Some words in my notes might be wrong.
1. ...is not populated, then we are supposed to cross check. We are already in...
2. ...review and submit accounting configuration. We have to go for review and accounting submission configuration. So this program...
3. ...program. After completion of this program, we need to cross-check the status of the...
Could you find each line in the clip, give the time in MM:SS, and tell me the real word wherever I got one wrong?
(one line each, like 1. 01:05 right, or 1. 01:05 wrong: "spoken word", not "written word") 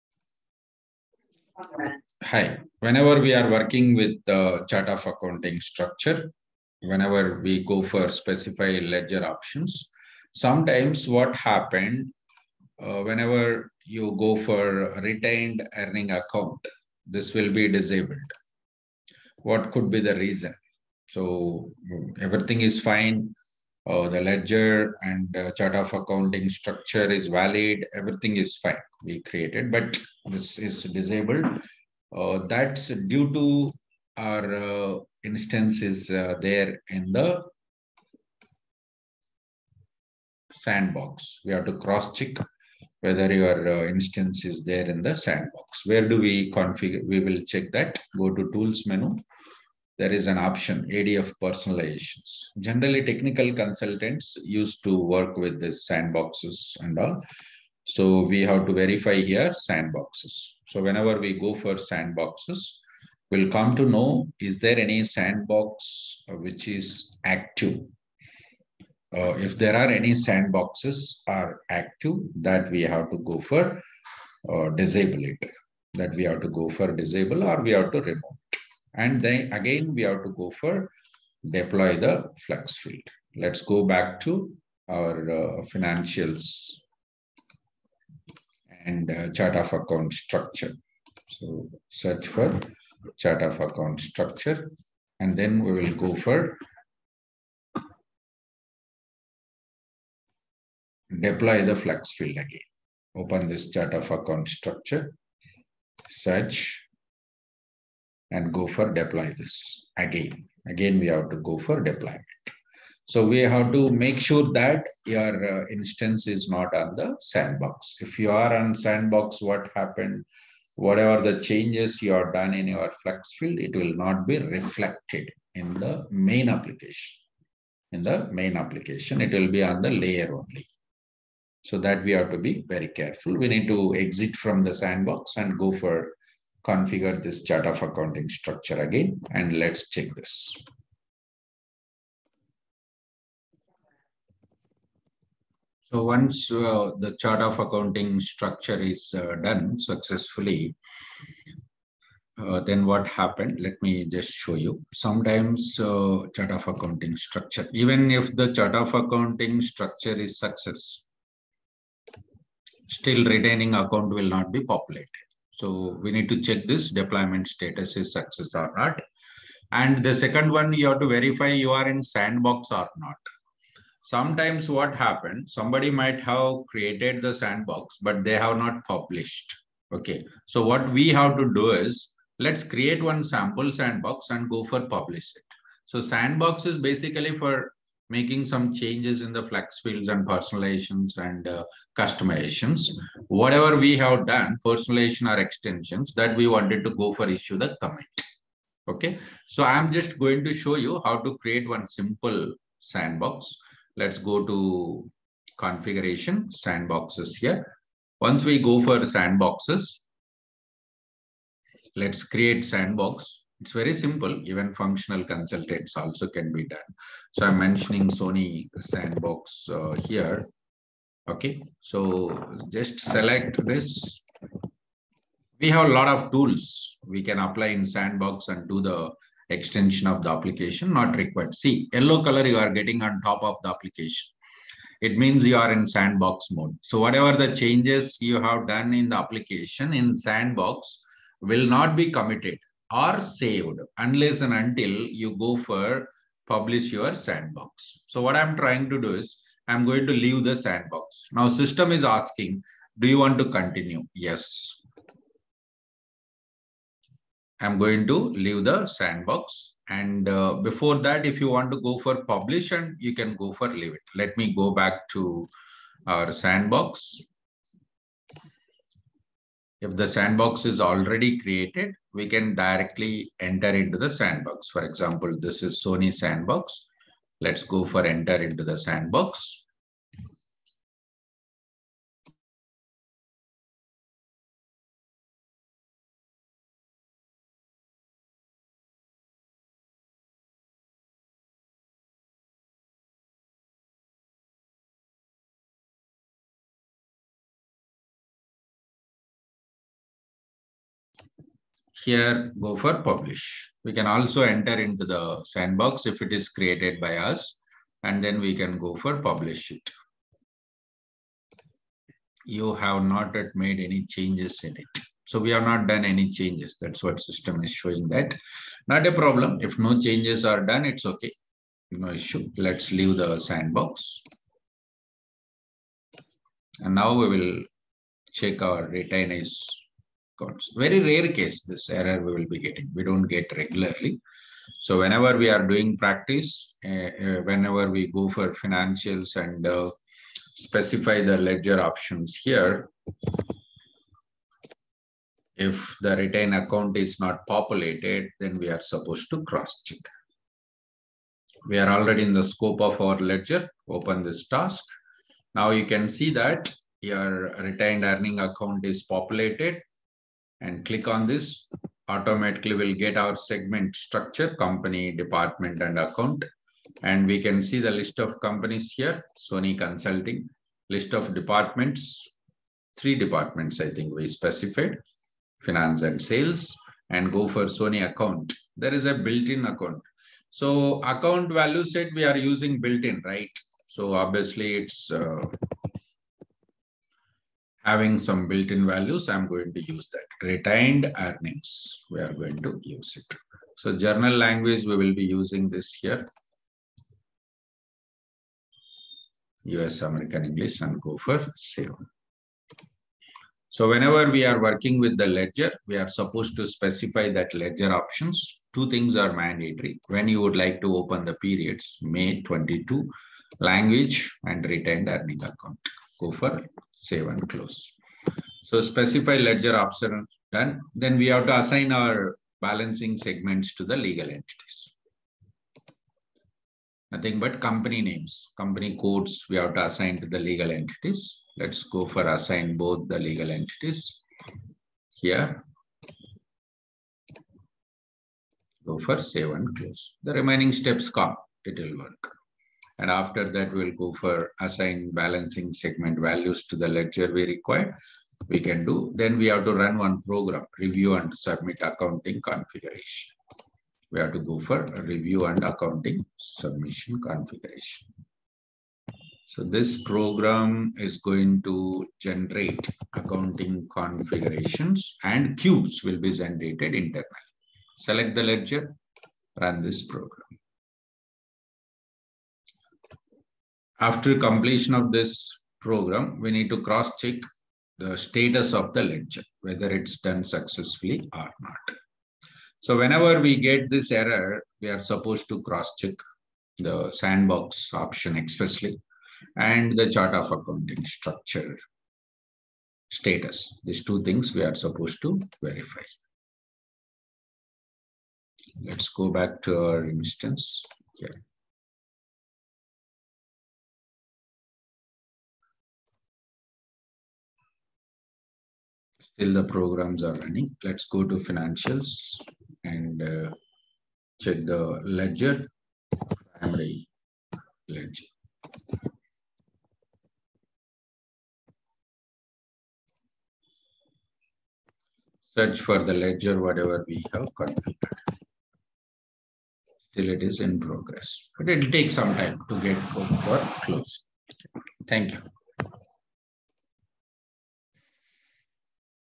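1. 05:46 right
2. 07:30 right
3. 07:50 right.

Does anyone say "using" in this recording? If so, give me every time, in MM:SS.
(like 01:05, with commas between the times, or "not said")
06:22, 06:35.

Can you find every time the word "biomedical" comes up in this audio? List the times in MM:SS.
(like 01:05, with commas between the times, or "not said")
not said.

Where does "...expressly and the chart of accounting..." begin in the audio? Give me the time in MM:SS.
08:08.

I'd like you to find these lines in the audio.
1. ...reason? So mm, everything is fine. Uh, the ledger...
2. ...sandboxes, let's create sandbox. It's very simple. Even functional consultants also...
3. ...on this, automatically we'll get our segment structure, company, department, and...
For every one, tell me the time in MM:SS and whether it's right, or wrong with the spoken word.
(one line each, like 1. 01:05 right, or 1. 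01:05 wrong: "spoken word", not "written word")
1. 00:20 right
2. 03:28 right
3. 06:01 right.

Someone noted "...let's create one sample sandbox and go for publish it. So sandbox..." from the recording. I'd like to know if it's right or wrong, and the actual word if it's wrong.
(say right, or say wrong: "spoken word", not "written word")
right.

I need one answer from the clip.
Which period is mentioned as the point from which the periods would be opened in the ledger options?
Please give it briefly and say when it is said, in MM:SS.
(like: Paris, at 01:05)
May 22, at 06:52.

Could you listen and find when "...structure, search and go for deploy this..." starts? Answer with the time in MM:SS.
01:44.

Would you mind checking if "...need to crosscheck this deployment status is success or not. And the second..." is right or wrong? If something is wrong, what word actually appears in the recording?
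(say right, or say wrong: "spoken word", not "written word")
wrong: "check", not "crosscheck".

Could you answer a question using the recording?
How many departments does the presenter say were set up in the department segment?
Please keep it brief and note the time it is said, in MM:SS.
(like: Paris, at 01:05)
3, at 06:12.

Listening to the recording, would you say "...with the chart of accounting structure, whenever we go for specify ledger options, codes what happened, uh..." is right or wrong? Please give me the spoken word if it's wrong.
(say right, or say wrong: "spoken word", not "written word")
wrong: "sometimes", not "codes".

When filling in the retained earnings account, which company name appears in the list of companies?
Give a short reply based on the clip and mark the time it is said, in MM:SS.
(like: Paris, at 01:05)
Sony Consulting, at 06:09.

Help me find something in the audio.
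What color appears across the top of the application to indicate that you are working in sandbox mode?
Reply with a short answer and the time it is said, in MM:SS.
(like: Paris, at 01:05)
Yellow, at 03:51.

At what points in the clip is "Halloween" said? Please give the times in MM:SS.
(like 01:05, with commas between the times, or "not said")
not said.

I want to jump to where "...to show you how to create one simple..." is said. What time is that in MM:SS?
03:20.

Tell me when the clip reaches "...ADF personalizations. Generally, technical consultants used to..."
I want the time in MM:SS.
00:50.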